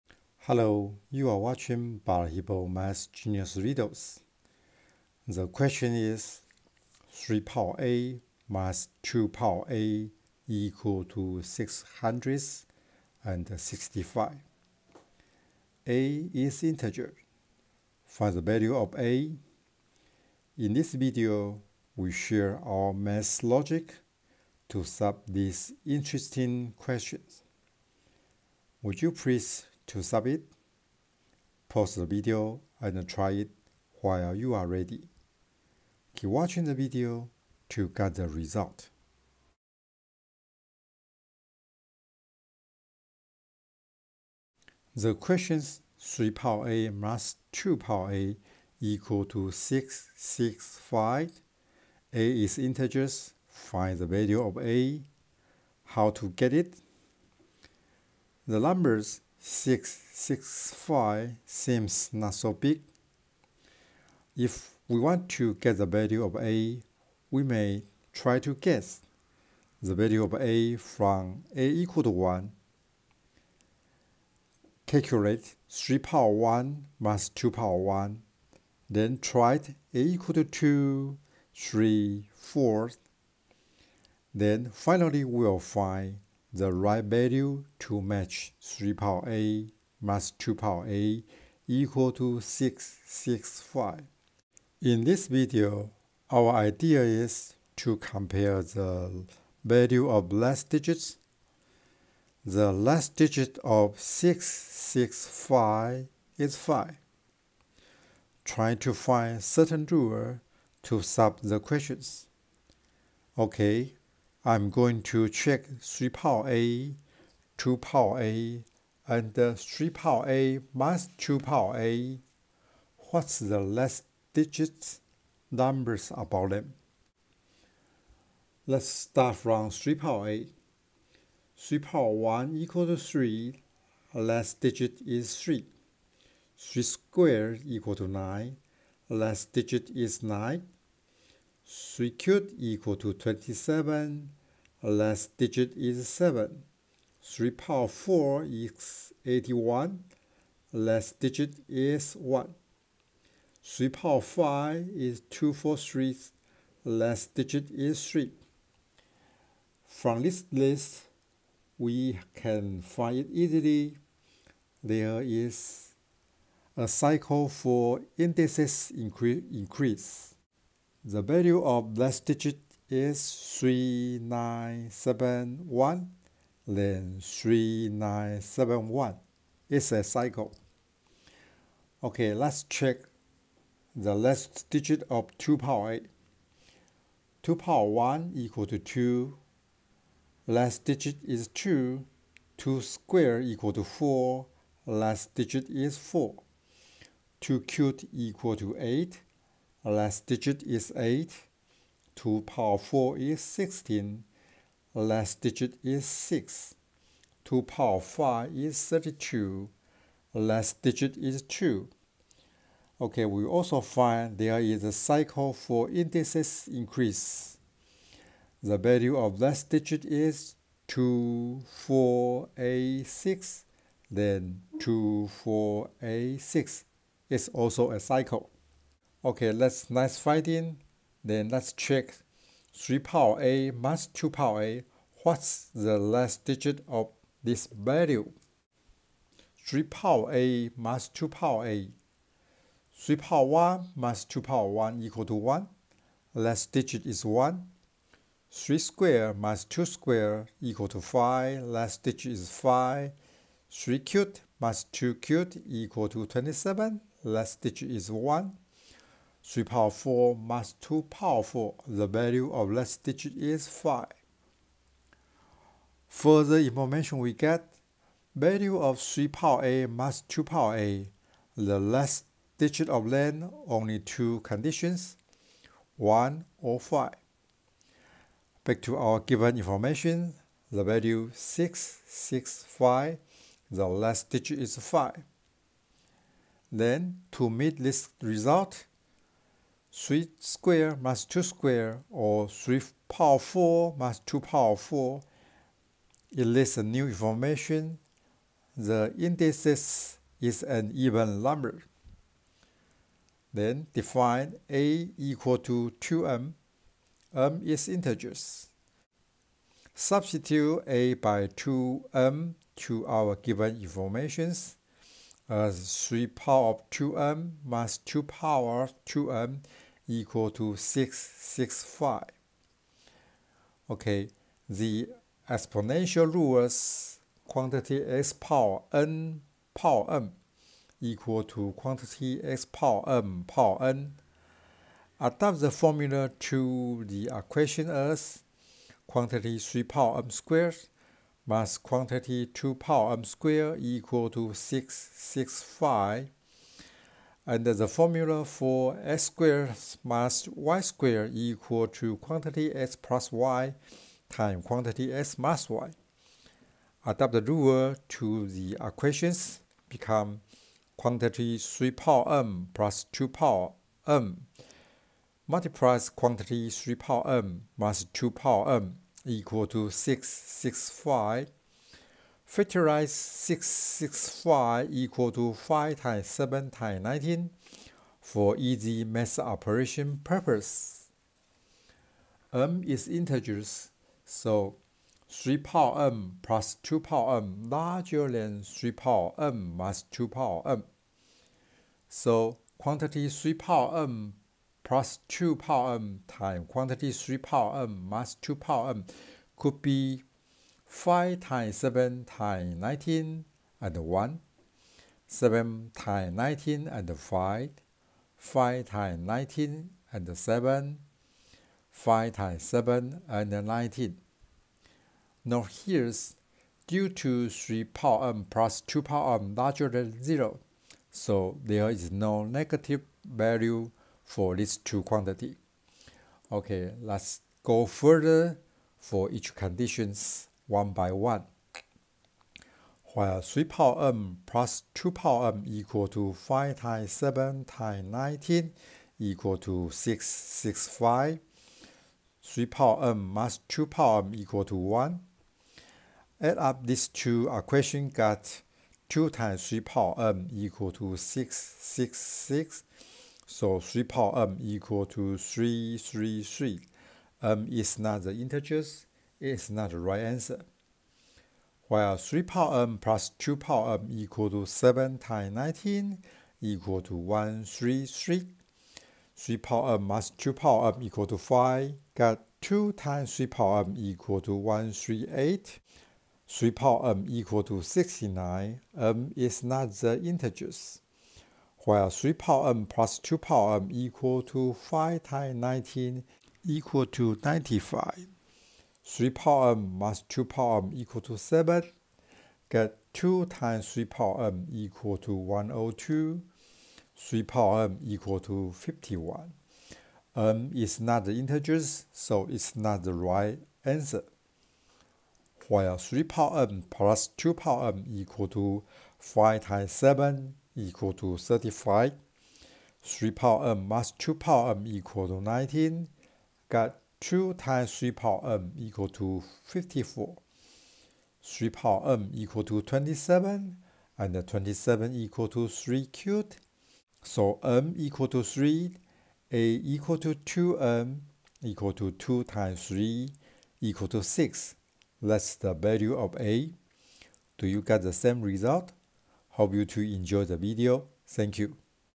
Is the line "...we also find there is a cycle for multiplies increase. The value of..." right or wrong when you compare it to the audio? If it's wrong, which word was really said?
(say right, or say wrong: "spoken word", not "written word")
wrong: "indices", not "multiplies".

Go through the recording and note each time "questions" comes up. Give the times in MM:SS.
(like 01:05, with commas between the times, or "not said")
00:05, 00:26, 00:45, 01:51.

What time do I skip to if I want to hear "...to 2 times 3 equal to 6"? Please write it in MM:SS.
08:51.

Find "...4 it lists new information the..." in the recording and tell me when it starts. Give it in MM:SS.
04:54.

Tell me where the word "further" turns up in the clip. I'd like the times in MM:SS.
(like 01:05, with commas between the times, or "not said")
04:26, 07:07.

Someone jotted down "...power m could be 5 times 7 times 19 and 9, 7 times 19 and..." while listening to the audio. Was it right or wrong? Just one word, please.
wrong.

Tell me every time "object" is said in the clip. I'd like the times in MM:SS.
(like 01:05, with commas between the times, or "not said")
not said.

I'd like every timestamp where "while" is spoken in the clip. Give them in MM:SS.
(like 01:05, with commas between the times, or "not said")
00:33, 07:13, 07:41, 08:01, 08:25.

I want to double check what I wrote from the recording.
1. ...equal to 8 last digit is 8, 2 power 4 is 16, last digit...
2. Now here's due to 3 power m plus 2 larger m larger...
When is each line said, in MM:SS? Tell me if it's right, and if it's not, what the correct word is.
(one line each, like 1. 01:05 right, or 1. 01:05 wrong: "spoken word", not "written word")
1. 03:18 right
2. 06:55 wrong: "power", not "larger".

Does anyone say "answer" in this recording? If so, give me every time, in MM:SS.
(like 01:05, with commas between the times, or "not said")
07:40, 08:23.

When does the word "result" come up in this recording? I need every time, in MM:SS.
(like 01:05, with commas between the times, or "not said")
00:38, 04:48, 08:58.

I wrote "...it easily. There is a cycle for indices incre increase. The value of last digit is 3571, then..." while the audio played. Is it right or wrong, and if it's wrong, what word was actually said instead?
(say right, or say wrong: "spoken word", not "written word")
wrong: "3971", not "3571".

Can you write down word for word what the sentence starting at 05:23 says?
Okay, the exponential rules quantity x power n power m equal to quantity x power m power n.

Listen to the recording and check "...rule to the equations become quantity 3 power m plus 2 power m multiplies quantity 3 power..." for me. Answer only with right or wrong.
right.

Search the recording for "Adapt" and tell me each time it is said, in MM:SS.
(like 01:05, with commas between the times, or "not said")
05:35, 05:57.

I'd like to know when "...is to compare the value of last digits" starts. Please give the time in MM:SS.
01:37.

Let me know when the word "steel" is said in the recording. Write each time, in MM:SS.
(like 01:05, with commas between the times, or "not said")
not said.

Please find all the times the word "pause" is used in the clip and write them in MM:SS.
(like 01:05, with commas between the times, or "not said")
00:31.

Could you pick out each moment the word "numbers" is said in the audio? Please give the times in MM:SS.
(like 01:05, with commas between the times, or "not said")
00:58, 02:05, 05:01.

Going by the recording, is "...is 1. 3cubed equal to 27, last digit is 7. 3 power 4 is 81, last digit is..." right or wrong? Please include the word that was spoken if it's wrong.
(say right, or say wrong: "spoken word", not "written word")
wrong: "9", not "1".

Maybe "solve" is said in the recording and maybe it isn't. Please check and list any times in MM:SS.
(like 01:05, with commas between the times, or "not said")
00:24, 01:51.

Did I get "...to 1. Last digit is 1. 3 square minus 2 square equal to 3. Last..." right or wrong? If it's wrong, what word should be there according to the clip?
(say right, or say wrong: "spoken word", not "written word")
wrong: "5", not "3".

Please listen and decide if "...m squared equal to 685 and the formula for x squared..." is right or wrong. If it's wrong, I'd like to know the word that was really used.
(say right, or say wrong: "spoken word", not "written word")
wrong: "665", not "685".